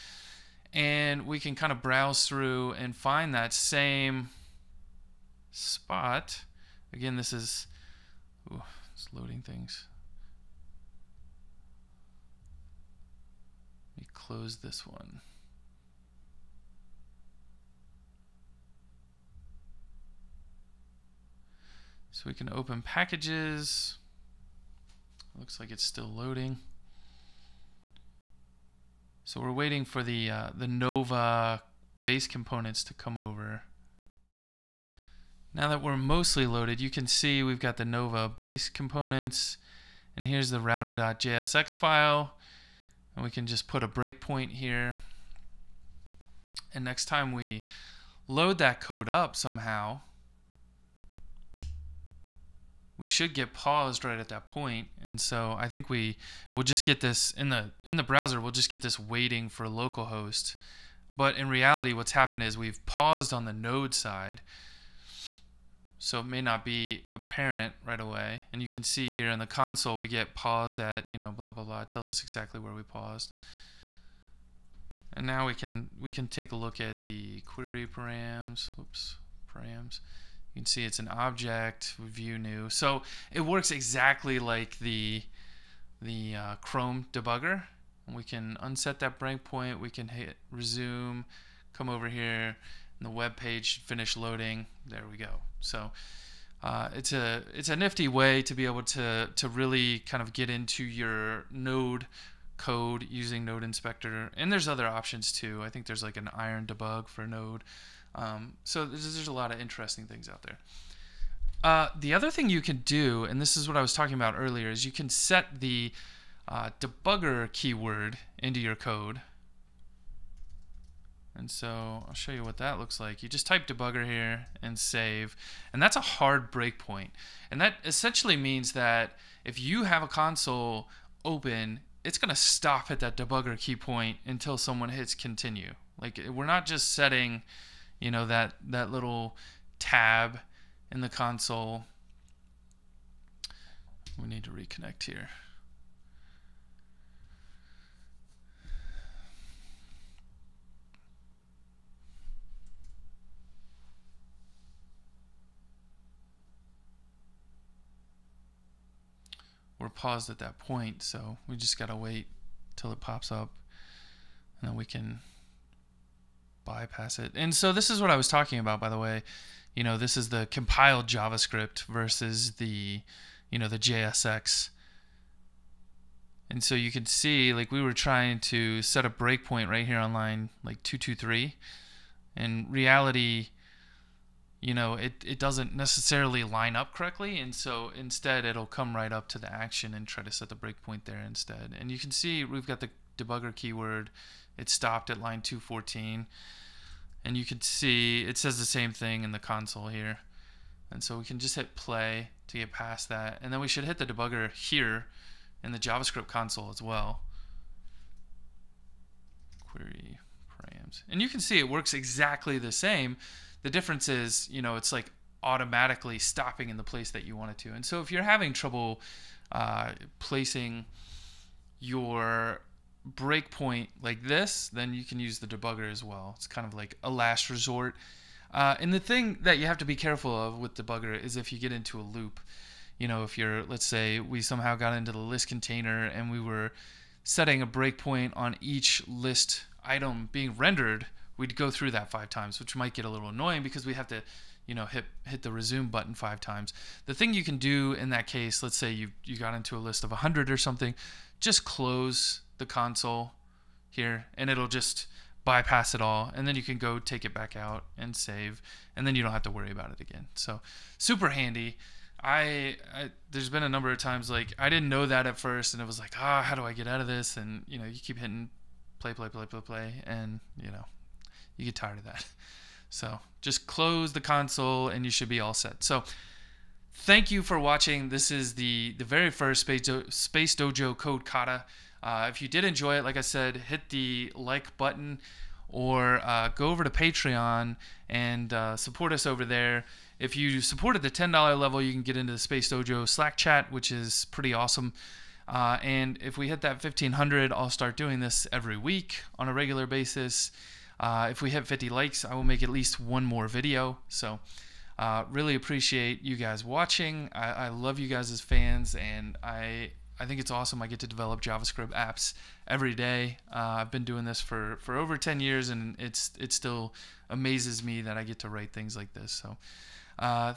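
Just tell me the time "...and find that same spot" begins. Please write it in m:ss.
0:02.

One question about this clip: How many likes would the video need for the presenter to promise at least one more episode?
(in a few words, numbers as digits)
50.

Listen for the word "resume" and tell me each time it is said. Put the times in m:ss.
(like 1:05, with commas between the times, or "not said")
1:30, 4:05.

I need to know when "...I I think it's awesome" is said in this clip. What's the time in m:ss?
5:09.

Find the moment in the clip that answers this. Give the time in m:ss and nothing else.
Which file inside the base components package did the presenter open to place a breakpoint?
0:40.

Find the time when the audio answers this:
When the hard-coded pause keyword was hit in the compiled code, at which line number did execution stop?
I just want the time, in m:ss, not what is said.
3:15.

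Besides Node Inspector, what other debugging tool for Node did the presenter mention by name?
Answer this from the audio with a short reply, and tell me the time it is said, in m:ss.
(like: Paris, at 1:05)
iron debug, at 1:46.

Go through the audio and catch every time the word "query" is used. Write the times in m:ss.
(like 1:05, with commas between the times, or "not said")
1:17, 3:29.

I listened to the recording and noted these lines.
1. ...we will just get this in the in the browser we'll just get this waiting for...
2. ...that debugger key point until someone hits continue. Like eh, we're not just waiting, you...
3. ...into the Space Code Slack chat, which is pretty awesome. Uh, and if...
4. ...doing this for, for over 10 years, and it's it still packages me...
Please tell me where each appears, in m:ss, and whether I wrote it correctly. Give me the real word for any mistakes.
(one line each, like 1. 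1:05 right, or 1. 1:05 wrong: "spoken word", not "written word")
1. 0:55 right
2. 2:12 wrong: "setting", not "waiting"
3. 4:52 wrong: "Dojo", not "Code"
4. 5:14 wrong: "amazes", not "packages".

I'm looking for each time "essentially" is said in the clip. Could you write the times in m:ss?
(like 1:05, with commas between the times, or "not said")
2:07.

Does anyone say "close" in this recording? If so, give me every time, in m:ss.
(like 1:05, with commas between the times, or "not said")
0:14, 4:11, 4:33.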